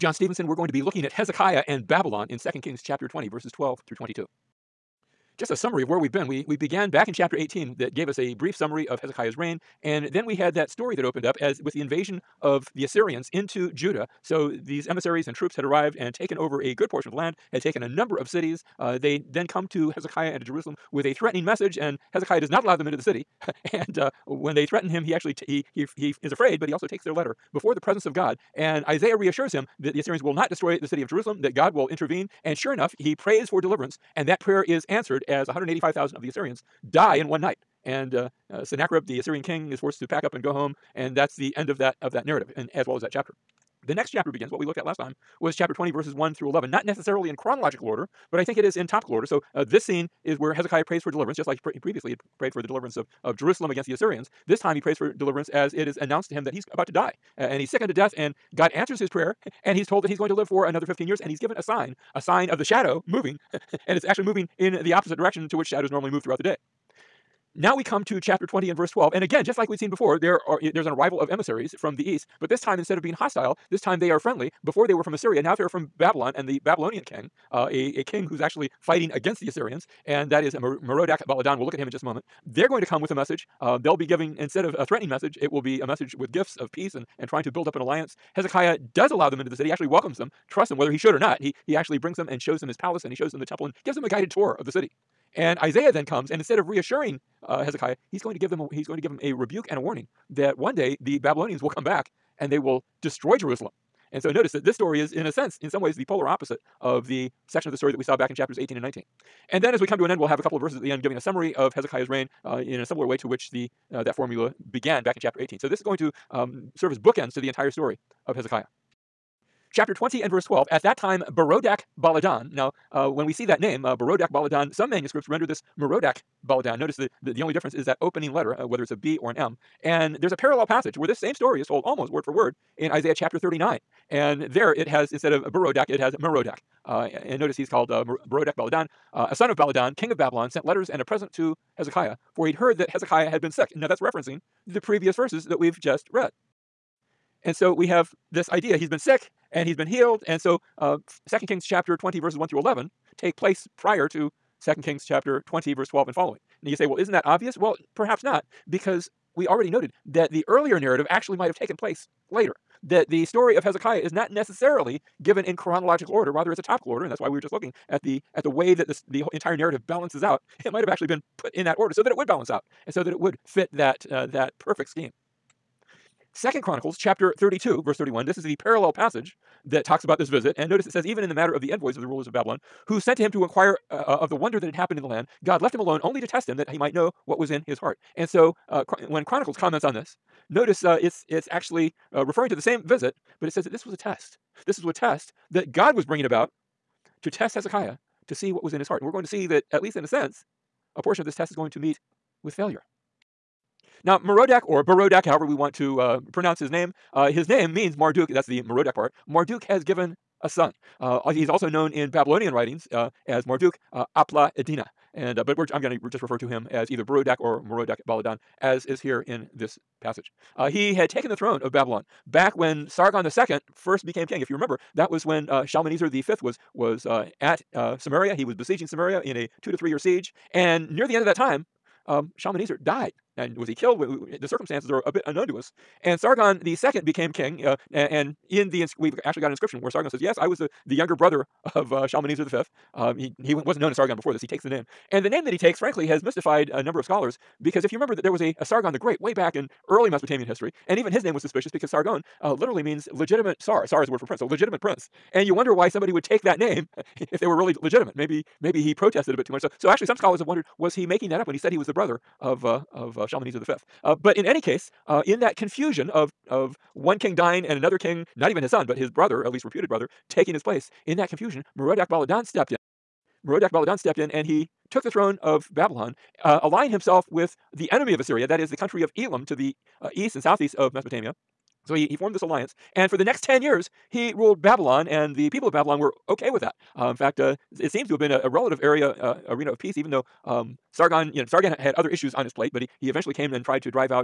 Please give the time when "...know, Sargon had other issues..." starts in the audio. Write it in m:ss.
4:51.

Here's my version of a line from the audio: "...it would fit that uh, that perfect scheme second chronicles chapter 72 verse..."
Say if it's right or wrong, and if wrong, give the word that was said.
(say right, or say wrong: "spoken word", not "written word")
wrong: "32", not "72".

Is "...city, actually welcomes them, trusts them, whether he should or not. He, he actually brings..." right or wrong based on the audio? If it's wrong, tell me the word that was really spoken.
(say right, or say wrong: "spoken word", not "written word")
right.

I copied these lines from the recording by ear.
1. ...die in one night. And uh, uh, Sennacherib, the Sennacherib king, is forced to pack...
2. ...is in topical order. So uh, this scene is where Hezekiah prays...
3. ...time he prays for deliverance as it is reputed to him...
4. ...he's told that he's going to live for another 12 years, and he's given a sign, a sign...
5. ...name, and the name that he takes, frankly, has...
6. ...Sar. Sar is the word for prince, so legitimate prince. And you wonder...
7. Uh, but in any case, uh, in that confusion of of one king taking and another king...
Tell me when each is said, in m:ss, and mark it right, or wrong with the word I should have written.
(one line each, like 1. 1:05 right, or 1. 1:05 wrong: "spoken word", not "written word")
1. 0:36 wrong: "Assyrian", not "Sennacherib"
2. 0:48 right
3. 0:54 wrong: "announced", not "reputed"
4. 0:59 wrong: "15", not "12"
5. 4:04 right
6. 4:13 right
7. 4:24 wrong: "dying", not "taking".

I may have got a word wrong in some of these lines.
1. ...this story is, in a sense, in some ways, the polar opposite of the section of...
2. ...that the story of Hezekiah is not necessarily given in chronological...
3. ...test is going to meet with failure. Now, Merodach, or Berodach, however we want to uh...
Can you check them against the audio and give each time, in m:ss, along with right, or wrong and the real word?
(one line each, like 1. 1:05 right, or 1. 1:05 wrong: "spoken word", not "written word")
1. 1:44 right
2. 2:42 right
3. 3:21 right.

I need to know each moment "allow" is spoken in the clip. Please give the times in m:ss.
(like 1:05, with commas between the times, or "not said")
0:22, 1:29.